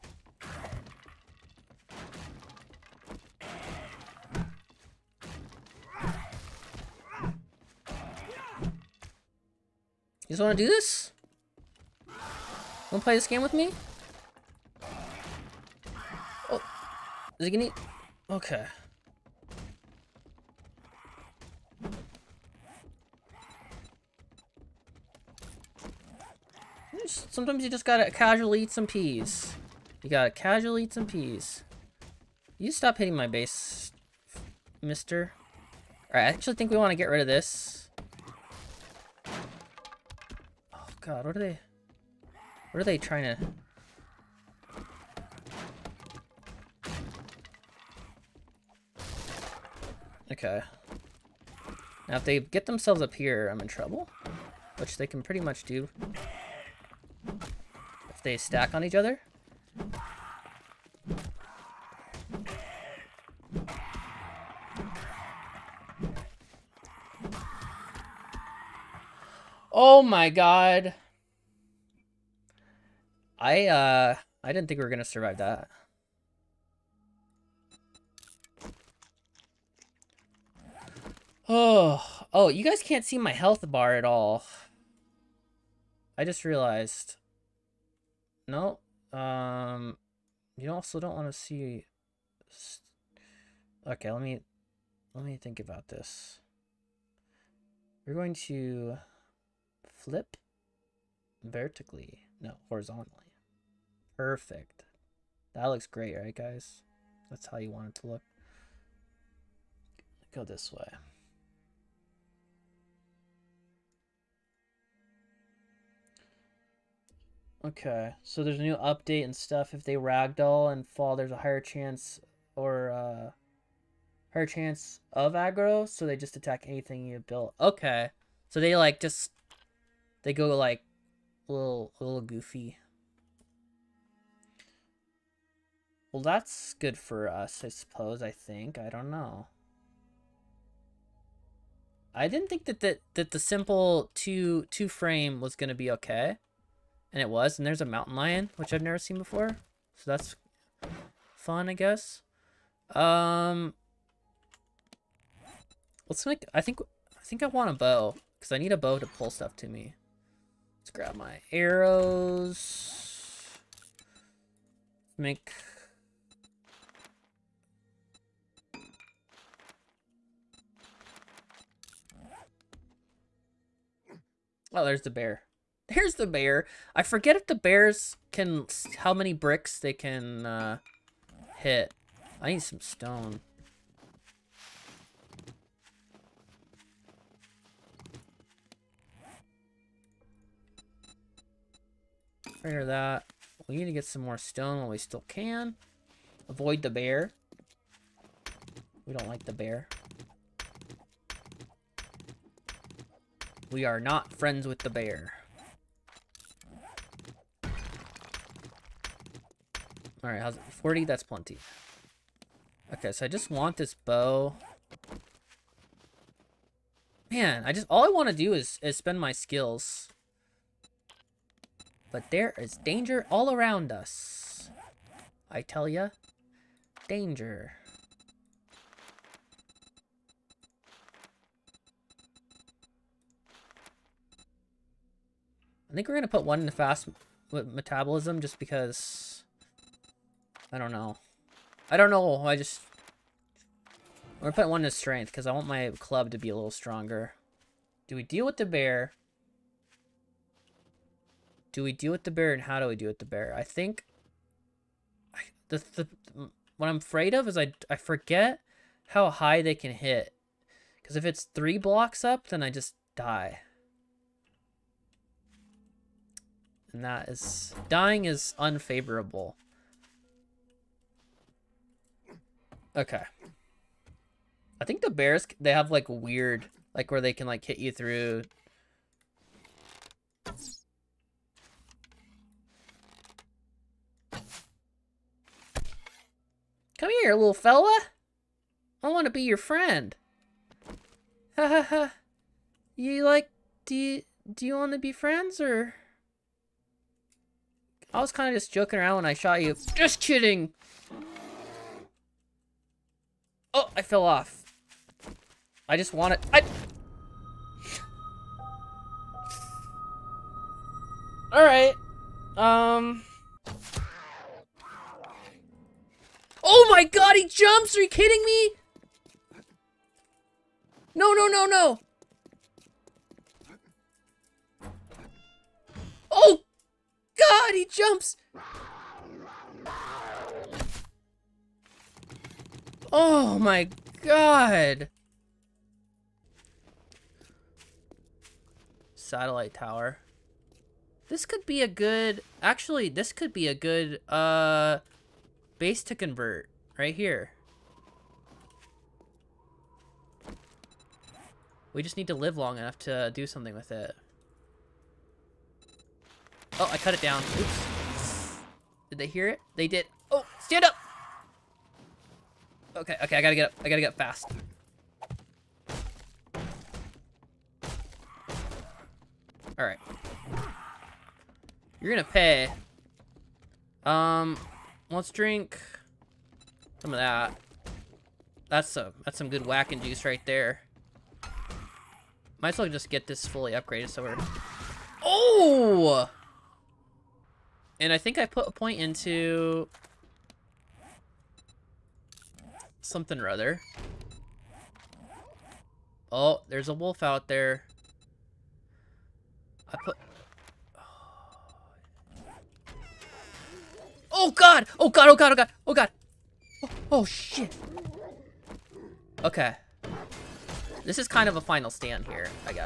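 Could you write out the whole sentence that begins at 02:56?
I forget if the bears can...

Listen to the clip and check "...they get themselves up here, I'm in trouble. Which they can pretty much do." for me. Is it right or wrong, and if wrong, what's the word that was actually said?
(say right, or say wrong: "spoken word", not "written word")
right.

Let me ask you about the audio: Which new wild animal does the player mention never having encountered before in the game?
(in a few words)
Mountain lion.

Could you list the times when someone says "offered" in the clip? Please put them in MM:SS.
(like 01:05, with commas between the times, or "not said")
not said.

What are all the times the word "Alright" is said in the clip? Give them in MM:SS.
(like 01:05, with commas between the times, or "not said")
00:36, 03:30, 05:11, 06:09.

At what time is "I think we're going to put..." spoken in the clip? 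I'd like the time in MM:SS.
03:55.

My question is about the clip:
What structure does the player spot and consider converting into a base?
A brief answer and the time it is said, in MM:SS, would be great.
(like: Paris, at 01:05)
Satellite tower, at 05:39.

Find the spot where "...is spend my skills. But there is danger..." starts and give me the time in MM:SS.
03:38.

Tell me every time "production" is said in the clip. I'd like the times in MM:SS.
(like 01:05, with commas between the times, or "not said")
not said.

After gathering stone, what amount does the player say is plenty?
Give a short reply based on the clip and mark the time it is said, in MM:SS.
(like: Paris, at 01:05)
40, at 03:30.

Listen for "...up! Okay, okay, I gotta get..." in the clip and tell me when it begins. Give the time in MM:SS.
06:00.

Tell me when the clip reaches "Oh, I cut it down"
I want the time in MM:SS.
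05:56.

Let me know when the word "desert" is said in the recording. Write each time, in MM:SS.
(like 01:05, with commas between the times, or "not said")
not said.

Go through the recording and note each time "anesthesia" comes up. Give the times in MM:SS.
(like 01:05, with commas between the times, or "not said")
not said.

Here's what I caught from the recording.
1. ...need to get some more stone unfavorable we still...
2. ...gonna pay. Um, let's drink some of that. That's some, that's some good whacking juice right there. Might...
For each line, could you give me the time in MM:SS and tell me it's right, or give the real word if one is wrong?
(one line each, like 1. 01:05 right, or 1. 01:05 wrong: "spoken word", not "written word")
1. 03:13 wrong: "while", not "unfavorable"
2. 06:12 right.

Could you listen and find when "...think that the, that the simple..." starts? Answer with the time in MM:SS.
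02:22.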